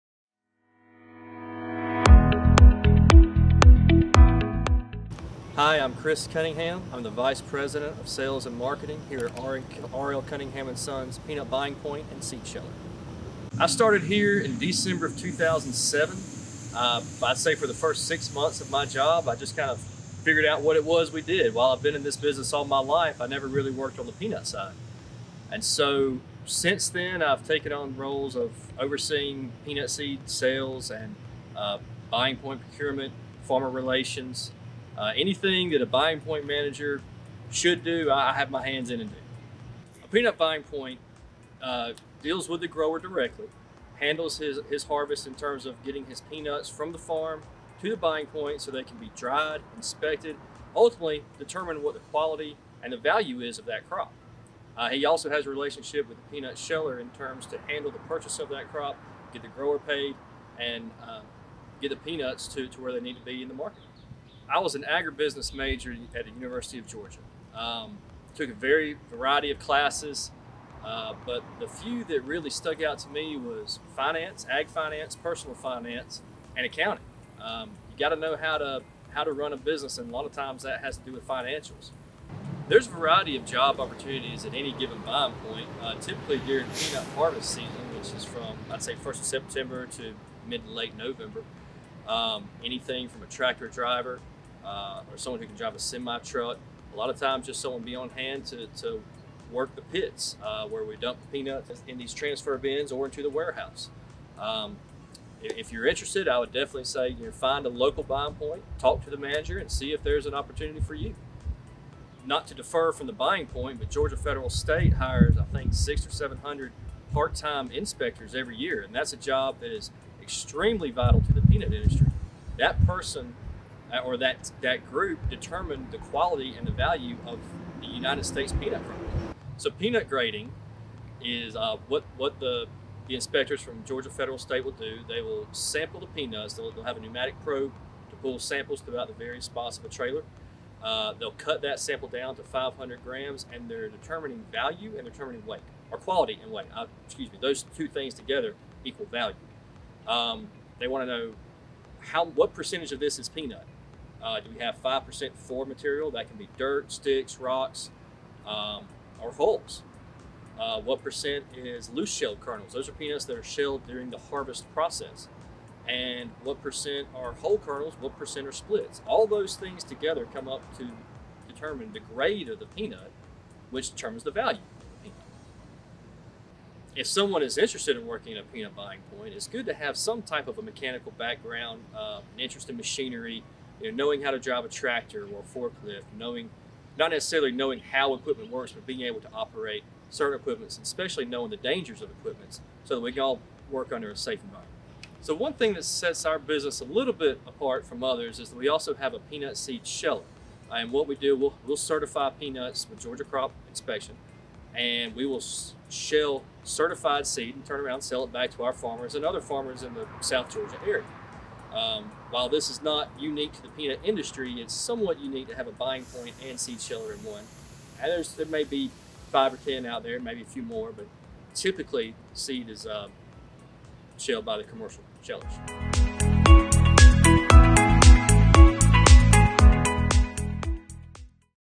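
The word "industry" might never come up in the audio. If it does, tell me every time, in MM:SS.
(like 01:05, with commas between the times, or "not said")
02:01, 03:34.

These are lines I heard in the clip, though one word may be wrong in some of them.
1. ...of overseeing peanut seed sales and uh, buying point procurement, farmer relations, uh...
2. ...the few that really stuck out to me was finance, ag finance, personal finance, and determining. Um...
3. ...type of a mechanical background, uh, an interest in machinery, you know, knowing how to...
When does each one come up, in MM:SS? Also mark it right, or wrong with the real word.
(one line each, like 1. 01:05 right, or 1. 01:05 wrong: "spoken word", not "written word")
1. 00:28 right
2. 01:11 wrong: "accounting", not "determining"
3. 03:00 right.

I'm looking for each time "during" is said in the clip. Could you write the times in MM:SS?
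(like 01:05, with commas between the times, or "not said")
01:26, 02:43.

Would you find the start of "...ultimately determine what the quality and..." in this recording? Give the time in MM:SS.
00:50.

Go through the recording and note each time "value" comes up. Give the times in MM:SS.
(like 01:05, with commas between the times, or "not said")
00:52, 02:06, 02:24, 02:29, 02:54.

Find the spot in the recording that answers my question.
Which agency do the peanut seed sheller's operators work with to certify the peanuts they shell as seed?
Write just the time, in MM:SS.
03:23.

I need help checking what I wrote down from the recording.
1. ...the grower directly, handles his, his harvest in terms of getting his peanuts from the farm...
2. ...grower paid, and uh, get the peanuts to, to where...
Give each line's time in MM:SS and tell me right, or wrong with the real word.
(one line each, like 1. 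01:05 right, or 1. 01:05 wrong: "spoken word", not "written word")
1. 00:42 right
2. 00:59 right.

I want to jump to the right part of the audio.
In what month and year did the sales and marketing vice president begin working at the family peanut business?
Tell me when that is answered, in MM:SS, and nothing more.
00:14.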